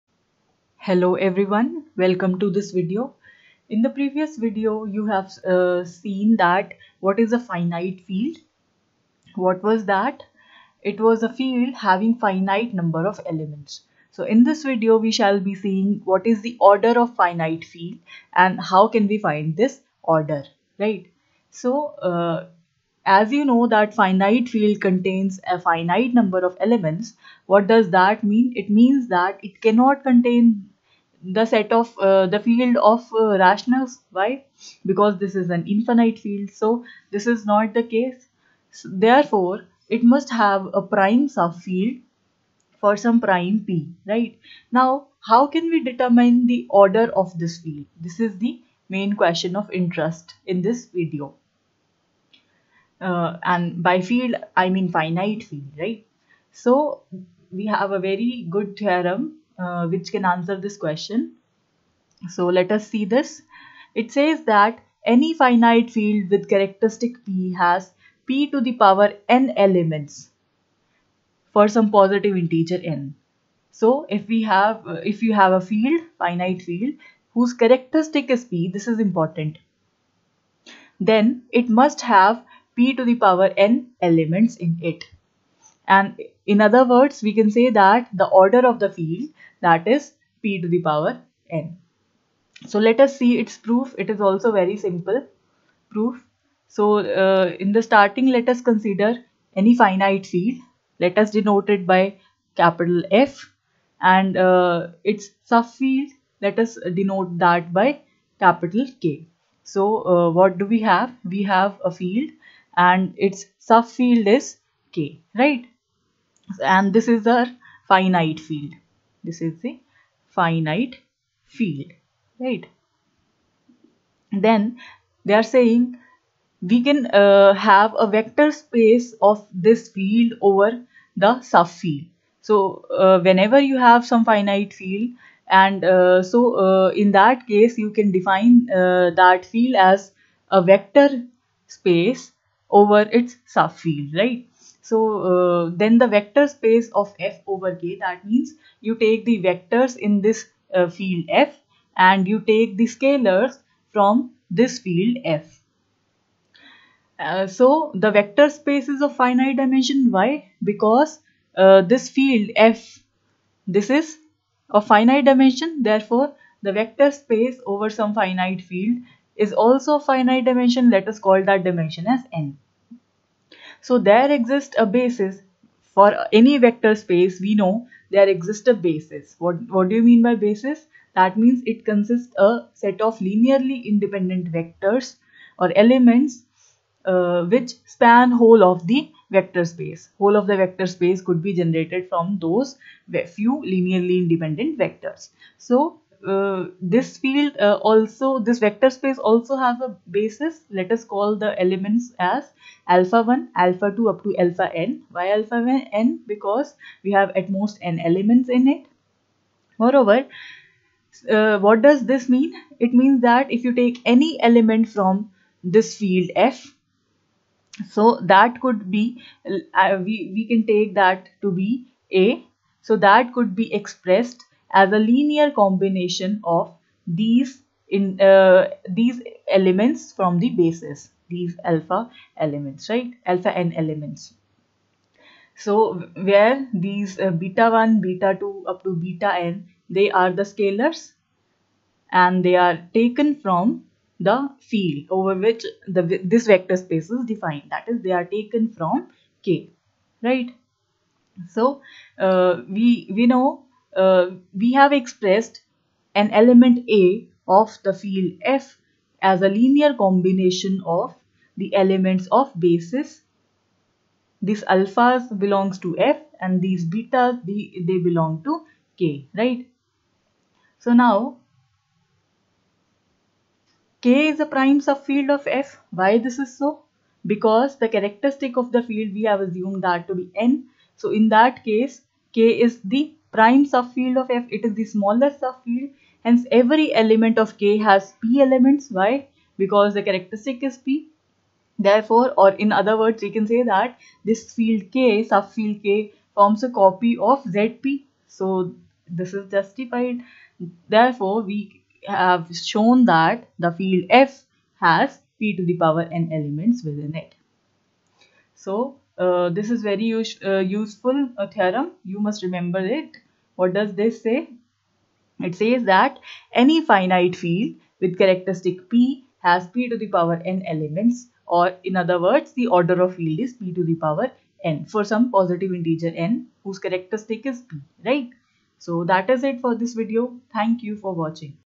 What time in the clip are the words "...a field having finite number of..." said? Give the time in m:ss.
0:11.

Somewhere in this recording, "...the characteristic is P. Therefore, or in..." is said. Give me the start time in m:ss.
4:49.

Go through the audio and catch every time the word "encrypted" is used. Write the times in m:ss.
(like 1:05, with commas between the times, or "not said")
not said.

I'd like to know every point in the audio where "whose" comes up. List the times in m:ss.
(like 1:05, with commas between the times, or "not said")
1:17, 5:26.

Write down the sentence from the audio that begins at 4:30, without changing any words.
So now K is a prime subfield of F.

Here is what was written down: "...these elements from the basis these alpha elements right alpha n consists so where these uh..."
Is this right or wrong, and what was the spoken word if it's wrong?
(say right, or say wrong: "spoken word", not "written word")
wrong: "elements", not "consists".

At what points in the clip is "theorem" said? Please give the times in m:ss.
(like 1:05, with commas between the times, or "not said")
0:58, 5:11.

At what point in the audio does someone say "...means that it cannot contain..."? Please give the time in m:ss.
0:28.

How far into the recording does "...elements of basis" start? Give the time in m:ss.
4:21.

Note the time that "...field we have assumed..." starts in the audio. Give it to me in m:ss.
4:38.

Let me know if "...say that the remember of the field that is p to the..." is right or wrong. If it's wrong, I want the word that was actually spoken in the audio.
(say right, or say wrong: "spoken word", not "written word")
wrong: "order", not "remember".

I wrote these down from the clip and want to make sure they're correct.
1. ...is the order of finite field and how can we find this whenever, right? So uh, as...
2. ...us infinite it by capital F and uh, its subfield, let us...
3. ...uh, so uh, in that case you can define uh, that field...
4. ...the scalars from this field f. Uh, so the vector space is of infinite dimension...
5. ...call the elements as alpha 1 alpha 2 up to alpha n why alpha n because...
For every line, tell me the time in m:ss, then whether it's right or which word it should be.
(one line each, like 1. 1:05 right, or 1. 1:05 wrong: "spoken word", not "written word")
1. 0:16 wrong: "order", not "whenever"
2. 1:41 wrong: "denote", not "infinite"
3. 2:15 right
4. 2:32 wrong: "finite", not "infinite"
5. 3:21 right.